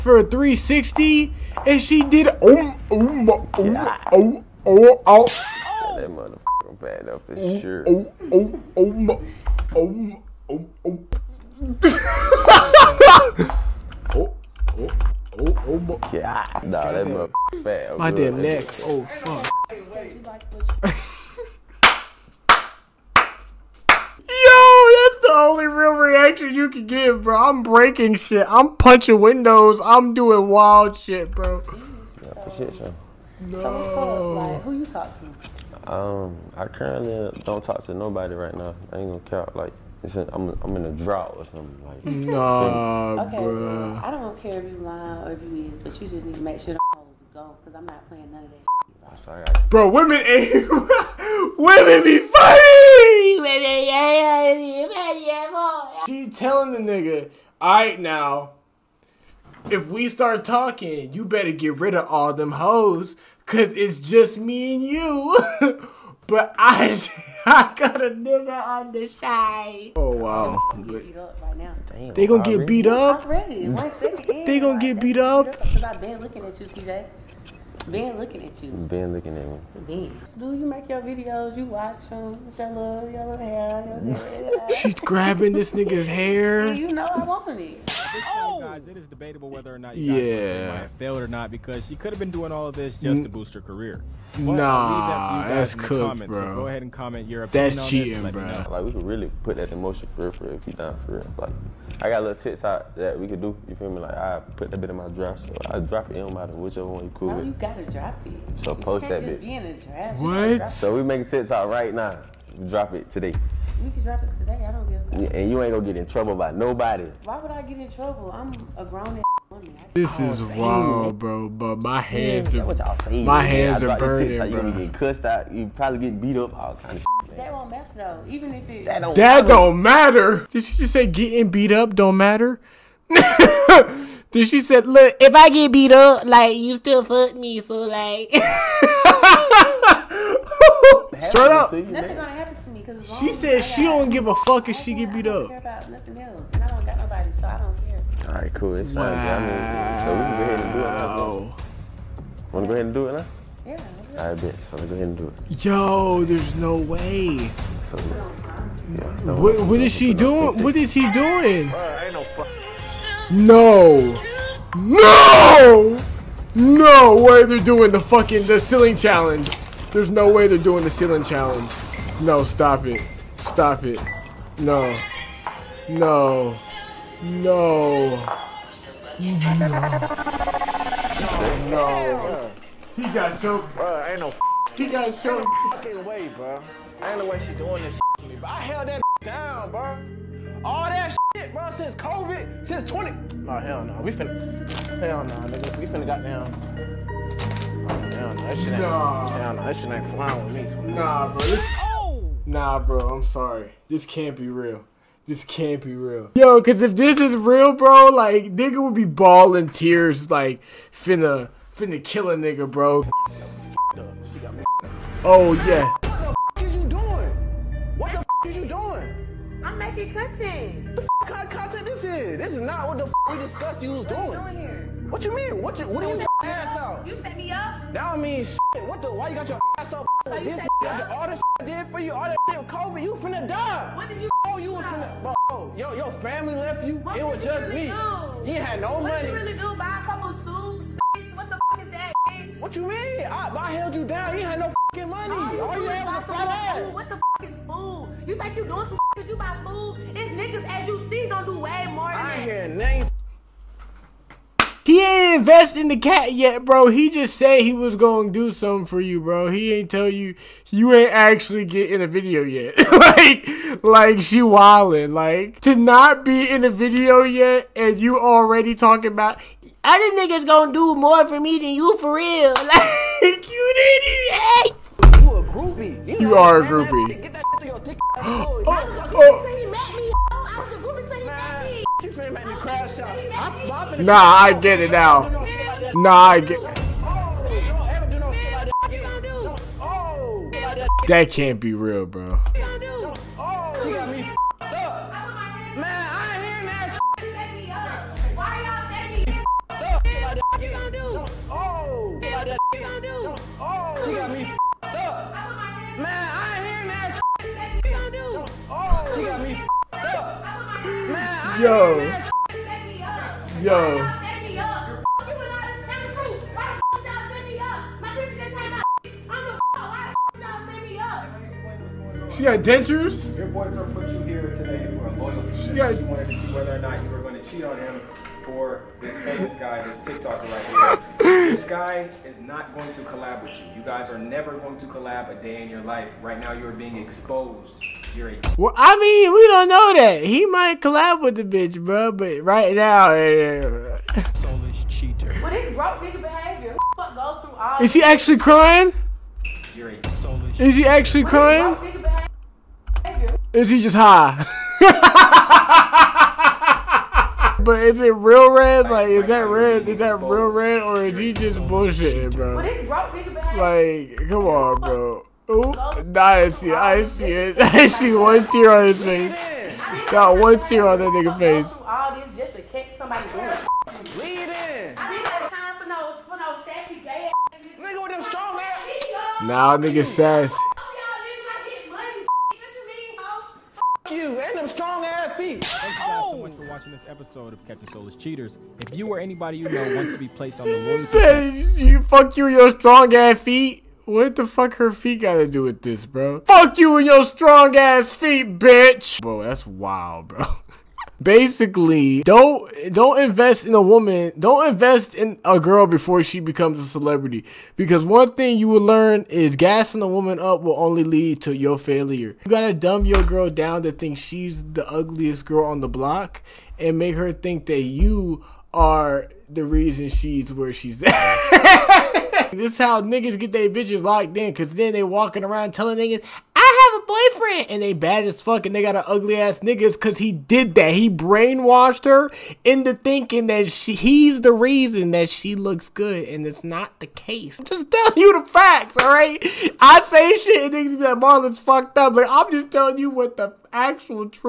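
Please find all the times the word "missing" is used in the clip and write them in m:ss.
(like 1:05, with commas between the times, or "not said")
not said.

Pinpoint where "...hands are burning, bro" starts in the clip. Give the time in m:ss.
2:03.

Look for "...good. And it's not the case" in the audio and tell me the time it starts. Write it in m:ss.
7:15.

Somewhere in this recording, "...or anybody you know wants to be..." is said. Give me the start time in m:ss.
6:29.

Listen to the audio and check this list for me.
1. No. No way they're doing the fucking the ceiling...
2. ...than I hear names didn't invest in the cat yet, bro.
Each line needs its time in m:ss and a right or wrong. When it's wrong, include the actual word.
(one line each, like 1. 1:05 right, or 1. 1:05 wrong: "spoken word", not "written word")
1. 2:44 right
2. 4:12 right.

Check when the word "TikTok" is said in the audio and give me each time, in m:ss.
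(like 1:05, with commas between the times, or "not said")
1:42, 1:51.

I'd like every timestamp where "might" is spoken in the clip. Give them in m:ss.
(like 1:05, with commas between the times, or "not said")
1:30, 5:40.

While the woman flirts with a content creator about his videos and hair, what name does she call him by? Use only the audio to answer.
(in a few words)
CJ.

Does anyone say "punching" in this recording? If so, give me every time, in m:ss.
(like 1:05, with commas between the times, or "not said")
0:28.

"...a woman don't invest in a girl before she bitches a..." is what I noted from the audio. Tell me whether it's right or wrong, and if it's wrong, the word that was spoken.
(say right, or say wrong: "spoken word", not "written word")
wrong: "becomes", not "bitches".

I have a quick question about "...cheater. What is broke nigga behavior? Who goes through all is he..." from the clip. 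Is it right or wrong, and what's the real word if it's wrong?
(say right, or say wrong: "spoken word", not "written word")
right.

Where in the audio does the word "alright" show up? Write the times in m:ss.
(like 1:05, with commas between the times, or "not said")
0:57.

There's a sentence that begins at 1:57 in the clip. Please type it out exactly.
Why would I get in trouble?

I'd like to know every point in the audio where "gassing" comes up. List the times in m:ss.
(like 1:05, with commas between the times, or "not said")
6:49.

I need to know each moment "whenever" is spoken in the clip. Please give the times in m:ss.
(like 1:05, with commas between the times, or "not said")
not said.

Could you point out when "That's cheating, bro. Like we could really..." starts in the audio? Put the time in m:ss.
1:37.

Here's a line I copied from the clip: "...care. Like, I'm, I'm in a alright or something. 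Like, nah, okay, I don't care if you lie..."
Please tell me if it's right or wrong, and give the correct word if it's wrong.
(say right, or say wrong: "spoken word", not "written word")
wrong: "drought", not "alright".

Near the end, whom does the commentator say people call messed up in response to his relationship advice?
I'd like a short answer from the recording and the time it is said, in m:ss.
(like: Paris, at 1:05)
Marland, at 7:21.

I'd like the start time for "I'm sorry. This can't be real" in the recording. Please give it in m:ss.
3:23.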